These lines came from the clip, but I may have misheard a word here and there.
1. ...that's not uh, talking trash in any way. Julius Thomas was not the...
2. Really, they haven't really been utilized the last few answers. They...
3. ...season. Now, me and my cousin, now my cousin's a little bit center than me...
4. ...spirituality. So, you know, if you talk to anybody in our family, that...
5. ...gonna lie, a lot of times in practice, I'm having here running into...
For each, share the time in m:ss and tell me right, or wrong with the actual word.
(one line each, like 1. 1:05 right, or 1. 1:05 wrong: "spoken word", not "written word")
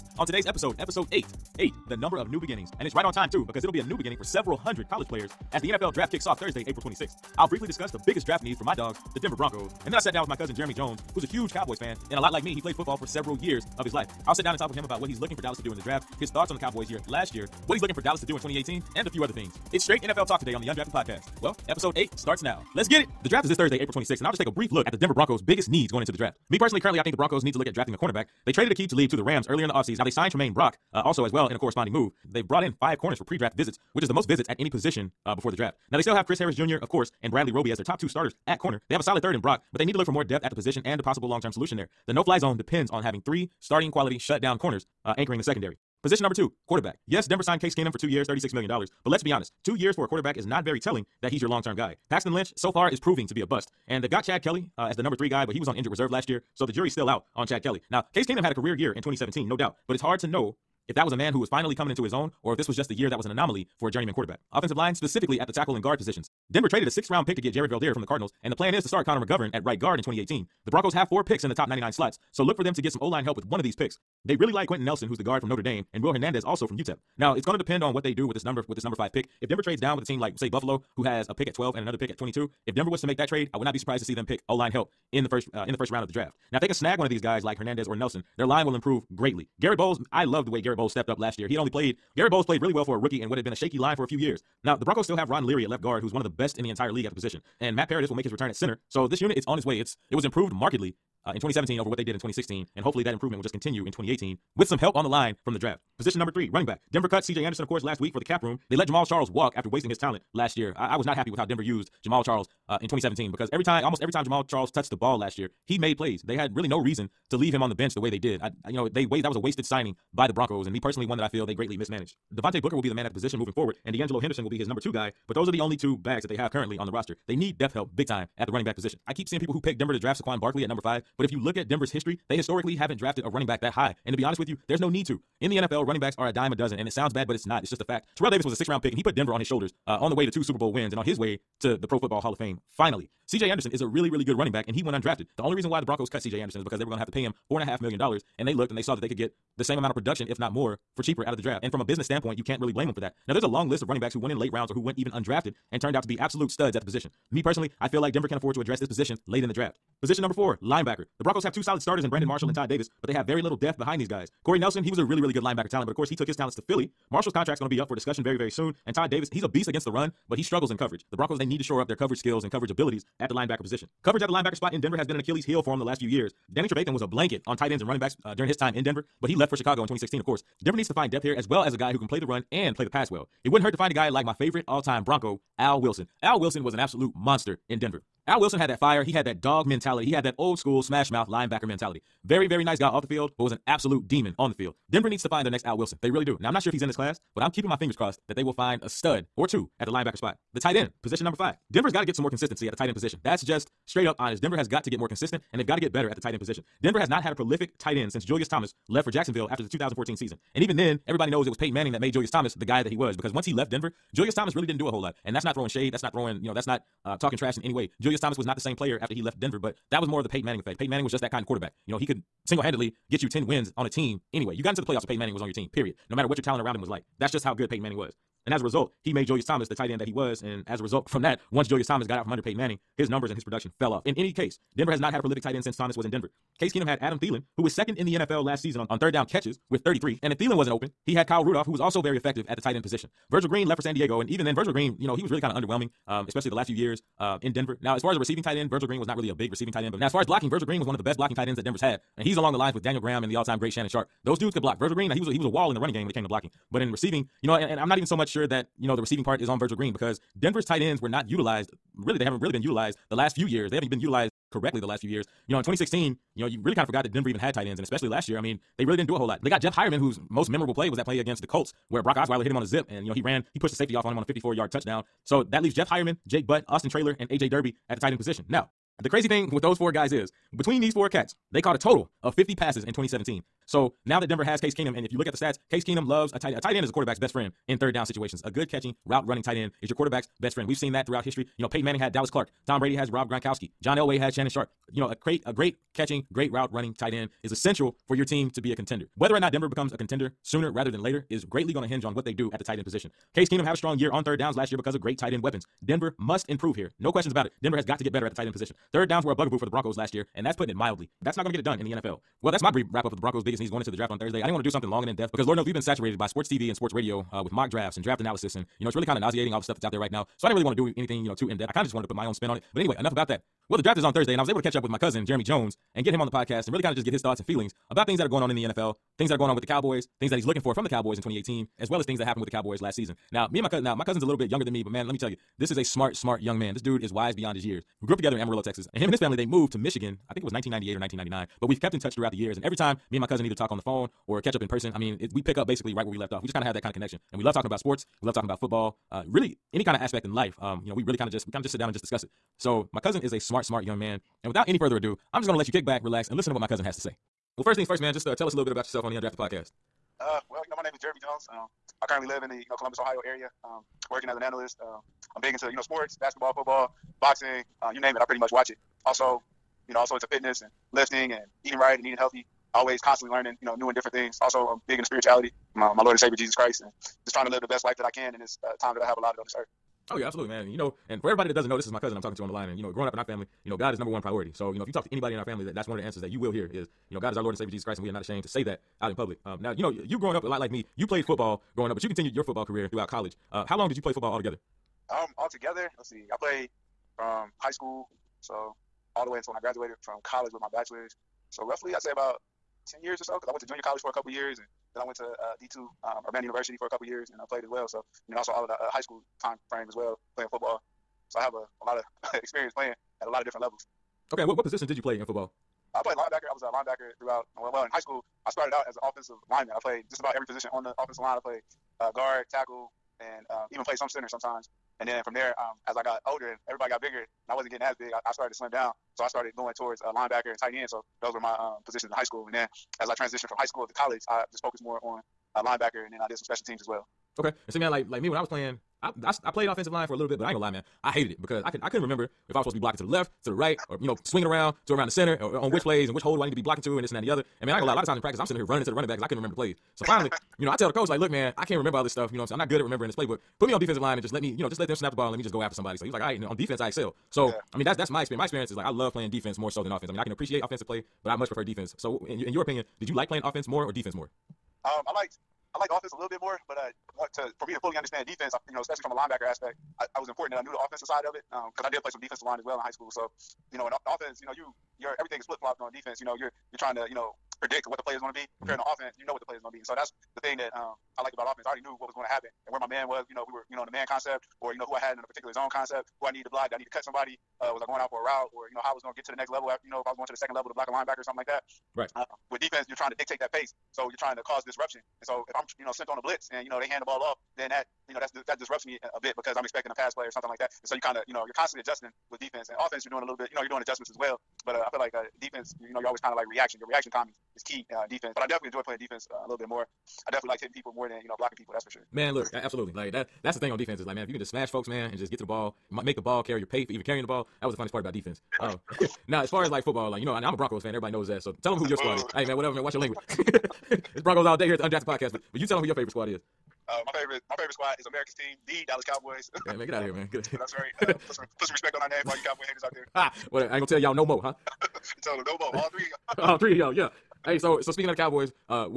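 1. 3:36 right
2. 4:21 wrong: "years", not "answers"
3. 5:32 wrong: "younger", not "center"
4. 6:24 wrong: "priority", not "spirituality"
5. 7:27 wrong: "sitting", not "having".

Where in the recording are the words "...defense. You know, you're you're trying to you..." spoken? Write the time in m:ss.
7:55.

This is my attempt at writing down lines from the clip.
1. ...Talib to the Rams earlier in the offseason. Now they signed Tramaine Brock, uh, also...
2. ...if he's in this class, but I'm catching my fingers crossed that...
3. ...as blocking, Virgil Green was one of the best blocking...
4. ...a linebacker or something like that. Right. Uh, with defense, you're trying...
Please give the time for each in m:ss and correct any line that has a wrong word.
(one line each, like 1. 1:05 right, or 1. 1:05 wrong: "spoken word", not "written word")
1. 0:28 right
2. 3:16 wrong: "keeping", not "catching"
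3. 4:10 right
4. 8:10 right.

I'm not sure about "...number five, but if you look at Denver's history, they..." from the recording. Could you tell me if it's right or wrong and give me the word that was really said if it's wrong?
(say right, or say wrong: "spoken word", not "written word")
right.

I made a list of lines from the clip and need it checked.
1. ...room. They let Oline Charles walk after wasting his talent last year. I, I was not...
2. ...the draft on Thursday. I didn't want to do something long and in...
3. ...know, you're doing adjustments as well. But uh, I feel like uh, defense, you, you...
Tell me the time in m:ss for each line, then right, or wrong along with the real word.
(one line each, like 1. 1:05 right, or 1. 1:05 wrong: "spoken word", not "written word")
1. 1:48 wrong: "Jamaal", not "Oline"
2. 5:13 right
3. 8:23 right.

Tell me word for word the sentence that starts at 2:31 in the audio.
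And from a business standpoint, you can't really blame them for that.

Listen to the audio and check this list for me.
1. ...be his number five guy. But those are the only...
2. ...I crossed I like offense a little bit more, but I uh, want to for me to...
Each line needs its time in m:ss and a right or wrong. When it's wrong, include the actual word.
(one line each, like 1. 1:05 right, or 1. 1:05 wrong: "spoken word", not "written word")
1. 2:04 wrong: "two", not "five"
2. 7:45 wrong: "liked", not "crossed".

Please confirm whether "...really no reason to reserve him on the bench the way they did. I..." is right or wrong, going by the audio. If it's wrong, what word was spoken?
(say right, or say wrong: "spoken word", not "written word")
wrong: "leave", not "reserve".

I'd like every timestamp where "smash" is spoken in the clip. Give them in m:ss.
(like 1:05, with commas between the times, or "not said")
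3:10, 8:34.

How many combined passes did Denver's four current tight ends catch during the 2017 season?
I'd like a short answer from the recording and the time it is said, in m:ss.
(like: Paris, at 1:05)
50, at 4:42.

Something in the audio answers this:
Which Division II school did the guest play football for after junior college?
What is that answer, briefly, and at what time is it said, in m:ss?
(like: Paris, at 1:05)
Urbana University, at 6:46.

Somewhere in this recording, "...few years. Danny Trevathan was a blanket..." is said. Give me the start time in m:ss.
2:55.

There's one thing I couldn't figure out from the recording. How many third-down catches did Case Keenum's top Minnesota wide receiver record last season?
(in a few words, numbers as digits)
33.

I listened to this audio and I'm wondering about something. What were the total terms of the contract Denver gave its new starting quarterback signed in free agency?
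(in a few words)
two years, $36 million.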